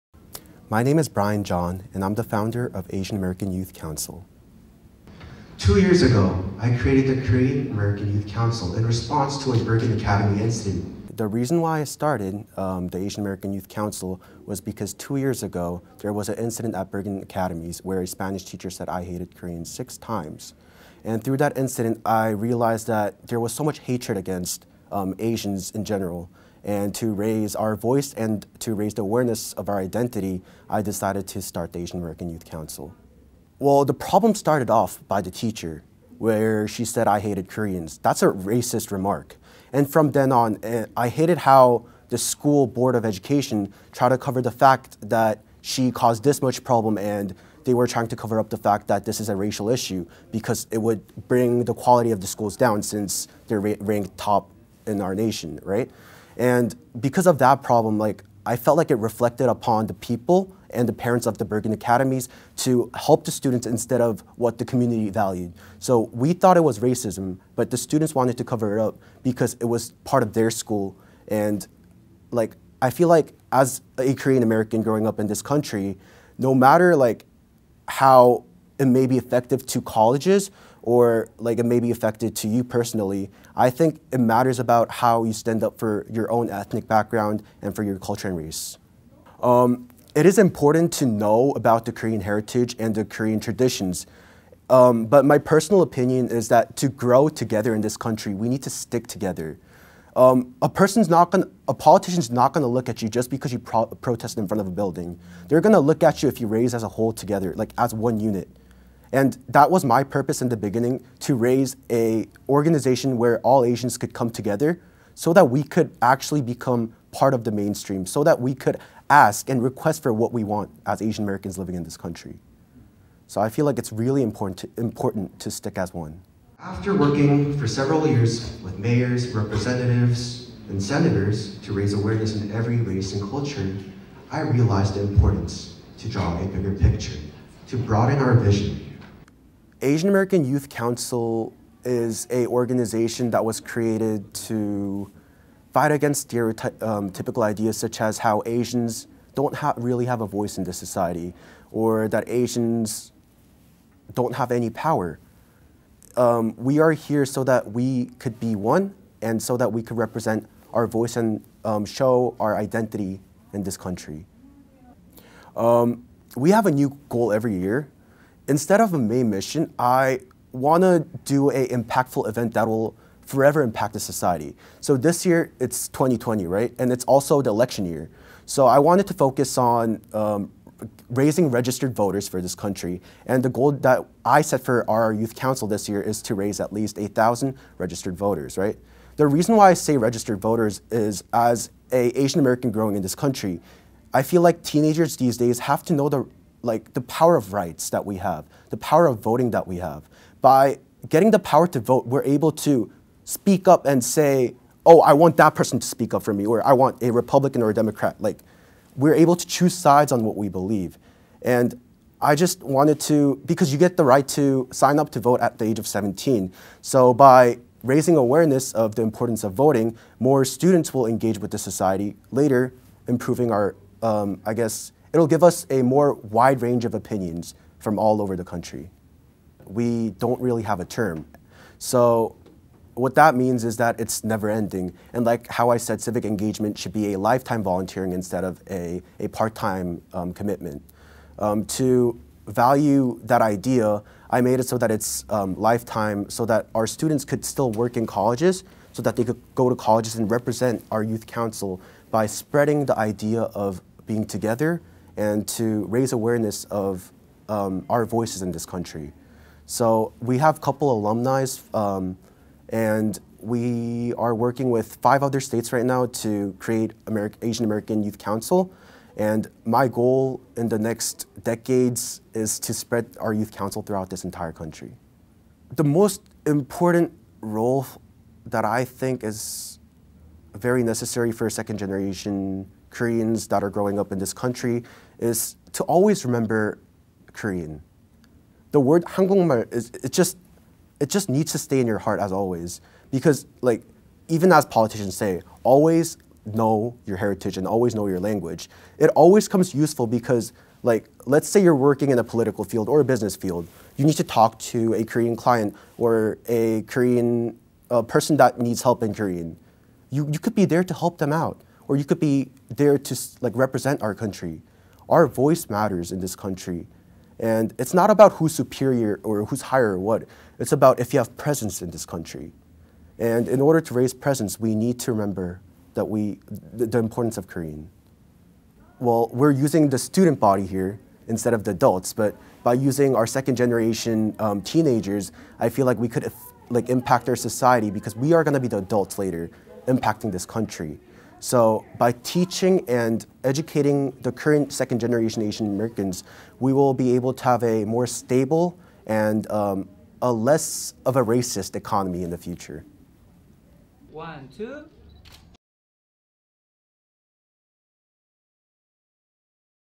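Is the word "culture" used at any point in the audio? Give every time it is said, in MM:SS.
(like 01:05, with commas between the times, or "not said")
01:27, 02:13.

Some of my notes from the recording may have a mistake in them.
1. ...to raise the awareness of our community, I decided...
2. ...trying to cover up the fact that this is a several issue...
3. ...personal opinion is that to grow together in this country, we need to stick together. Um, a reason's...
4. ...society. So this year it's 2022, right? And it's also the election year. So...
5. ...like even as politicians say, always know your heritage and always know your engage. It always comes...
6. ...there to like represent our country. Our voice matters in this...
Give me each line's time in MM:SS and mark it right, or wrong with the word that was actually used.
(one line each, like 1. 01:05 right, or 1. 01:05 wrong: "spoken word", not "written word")
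1. 00:28 wrong: "identity", not "community"
2. 00:47 wrong: "racial", not "several"
3. 01:35 wrong: "person", not "reason"
4. 02:53 wrong: "2020", not "2022"
5. 04:53 wrong: "language", not "engage"
6. 05:12 right.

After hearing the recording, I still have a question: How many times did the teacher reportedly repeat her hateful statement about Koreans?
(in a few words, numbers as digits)
6.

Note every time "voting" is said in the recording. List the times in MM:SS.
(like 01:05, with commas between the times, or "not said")
03:19, 03:39.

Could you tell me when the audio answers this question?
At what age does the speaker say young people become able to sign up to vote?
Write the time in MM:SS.
03:35.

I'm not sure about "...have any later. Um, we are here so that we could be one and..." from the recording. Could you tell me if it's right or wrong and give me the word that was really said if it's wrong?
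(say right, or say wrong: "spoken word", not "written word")
wrong: "power", not "later".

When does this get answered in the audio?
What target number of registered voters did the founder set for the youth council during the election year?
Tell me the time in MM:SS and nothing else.
03:06.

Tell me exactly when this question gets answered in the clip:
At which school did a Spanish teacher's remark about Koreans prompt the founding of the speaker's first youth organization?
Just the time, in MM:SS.
00:09.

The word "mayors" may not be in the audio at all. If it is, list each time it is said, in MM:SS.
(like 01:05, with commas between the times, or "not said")
02:08.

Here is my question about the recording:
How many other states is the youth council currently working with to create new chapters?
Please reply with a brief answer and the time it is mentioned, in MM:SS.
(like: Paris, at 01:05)
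5, at 04:25.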